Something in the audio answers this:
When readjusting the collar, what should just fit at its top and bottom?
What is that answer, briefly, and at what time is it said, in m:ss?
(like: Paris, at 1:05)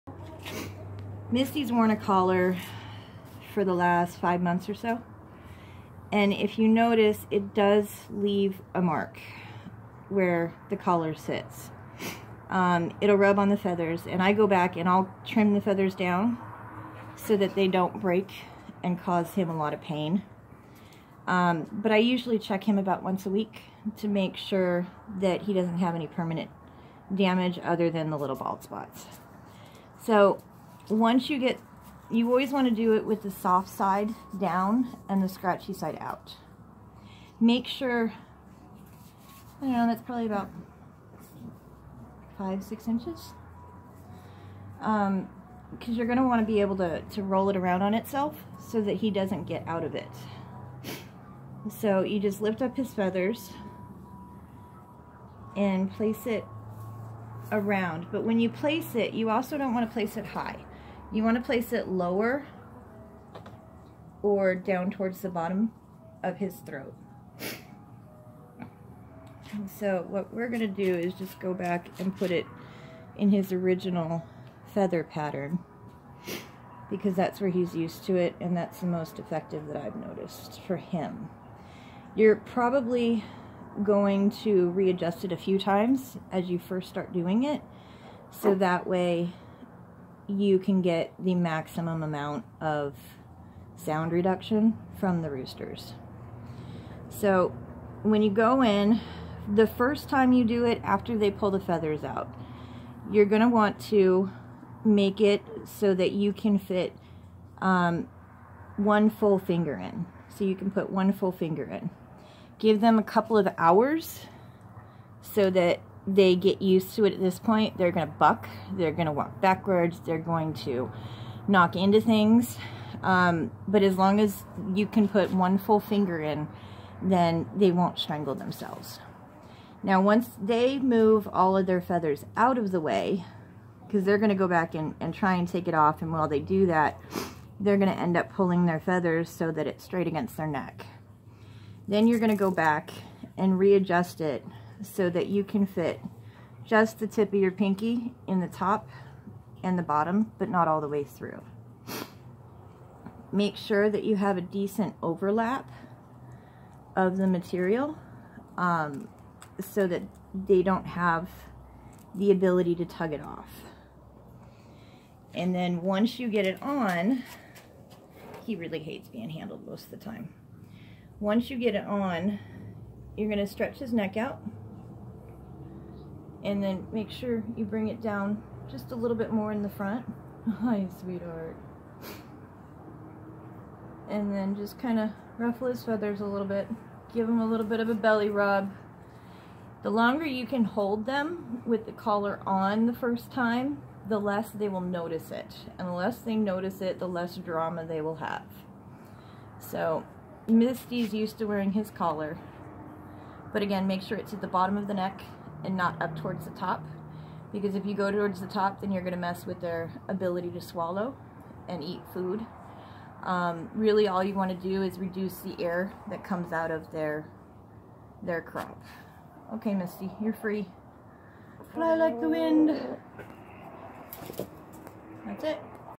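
Tip of your pinky, at 2:27.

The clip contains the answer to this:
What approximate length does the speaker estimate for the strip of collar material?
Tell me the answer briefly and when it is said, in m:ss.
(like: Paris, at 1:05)
5 or 6 inches, at 0:42.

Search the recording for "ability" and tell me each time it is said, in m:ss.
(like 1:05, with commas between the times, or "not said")
2:42, 3:30.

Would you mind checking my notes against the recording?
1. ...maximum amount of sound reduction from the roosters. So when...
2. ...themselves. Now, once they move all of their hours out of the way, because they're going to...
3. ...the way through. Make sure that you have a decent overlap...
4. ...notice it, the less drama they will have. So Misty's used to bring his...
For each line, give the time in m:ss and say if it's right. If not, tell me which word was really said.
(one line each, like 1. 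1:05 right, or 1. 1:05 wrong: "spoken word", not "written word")
1. 1:31 right
2. 2:08 wrong: "feathers", not "hours"
3. 2:30 right
4. 3:16 wrong: "wearing", not "bring".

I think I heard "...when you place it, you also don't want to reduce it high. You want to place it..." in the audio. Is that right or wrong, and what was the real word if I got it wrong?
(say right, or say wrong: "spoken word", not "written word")
wrong: "place", not "reduce".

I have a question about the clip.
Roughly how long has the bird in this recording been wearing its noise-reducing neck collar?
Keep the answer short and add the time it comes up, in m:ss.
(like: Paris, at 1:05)
5 months, at 0:04.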